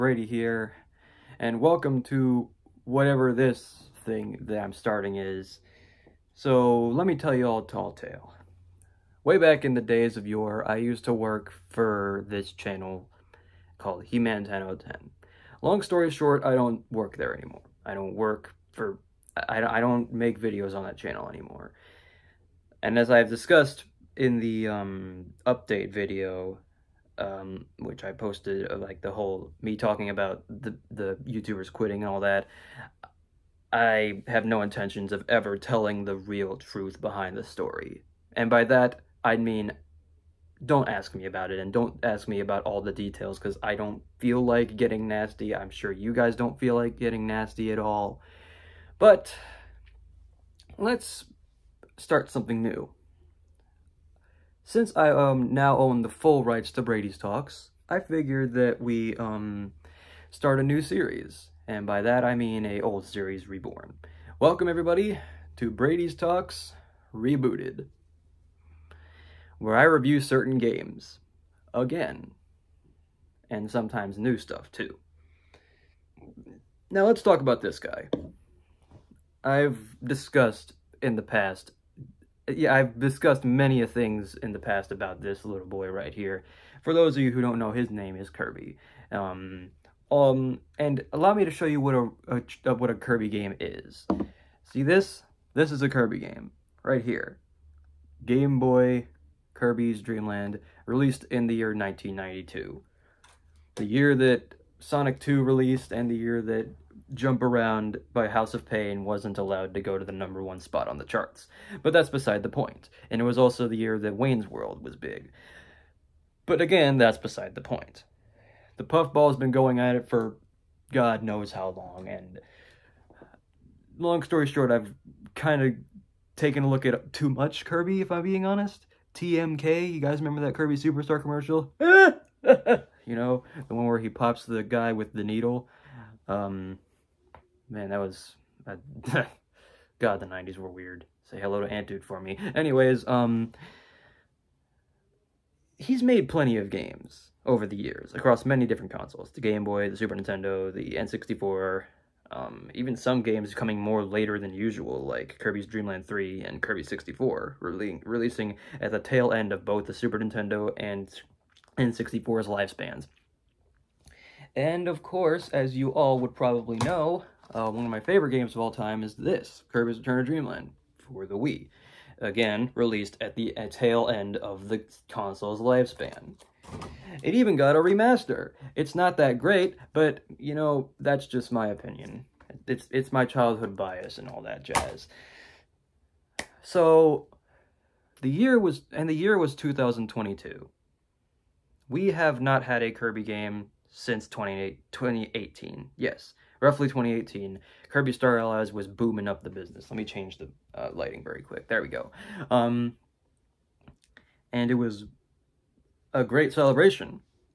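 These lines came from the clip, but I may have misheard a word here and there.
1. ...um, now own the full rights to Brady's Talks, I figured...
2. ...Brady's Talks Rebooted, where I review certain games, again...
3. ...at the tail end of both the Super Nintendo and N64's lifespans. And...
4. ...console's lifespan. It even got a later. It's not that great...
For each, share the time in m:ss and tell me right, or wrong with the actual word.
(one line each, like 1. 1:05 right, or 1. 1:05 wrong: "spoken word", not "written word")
1. 0:55 right
2. 1:05 right
3. 2:38 right
4. 2:55 wrong: "remaster", not "later".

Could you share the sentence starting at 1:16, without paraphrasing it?
Now let's talk about this guy.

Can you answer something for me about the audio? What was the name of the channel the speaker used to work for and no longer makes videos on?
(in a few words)
He-Man 1010.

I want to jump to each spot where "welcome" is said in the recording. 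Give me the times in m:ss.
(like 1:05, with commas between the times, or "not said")
0:01, 1:04.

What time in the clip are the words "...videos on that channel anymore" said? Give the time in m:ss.
0:20.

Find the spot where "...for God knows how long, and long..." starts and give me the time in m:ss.
2:00.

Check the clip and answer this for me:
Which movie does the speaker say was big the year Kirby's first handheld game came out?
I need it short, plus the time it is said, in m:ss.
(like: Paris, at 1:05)
Wayne's World, at 1:54.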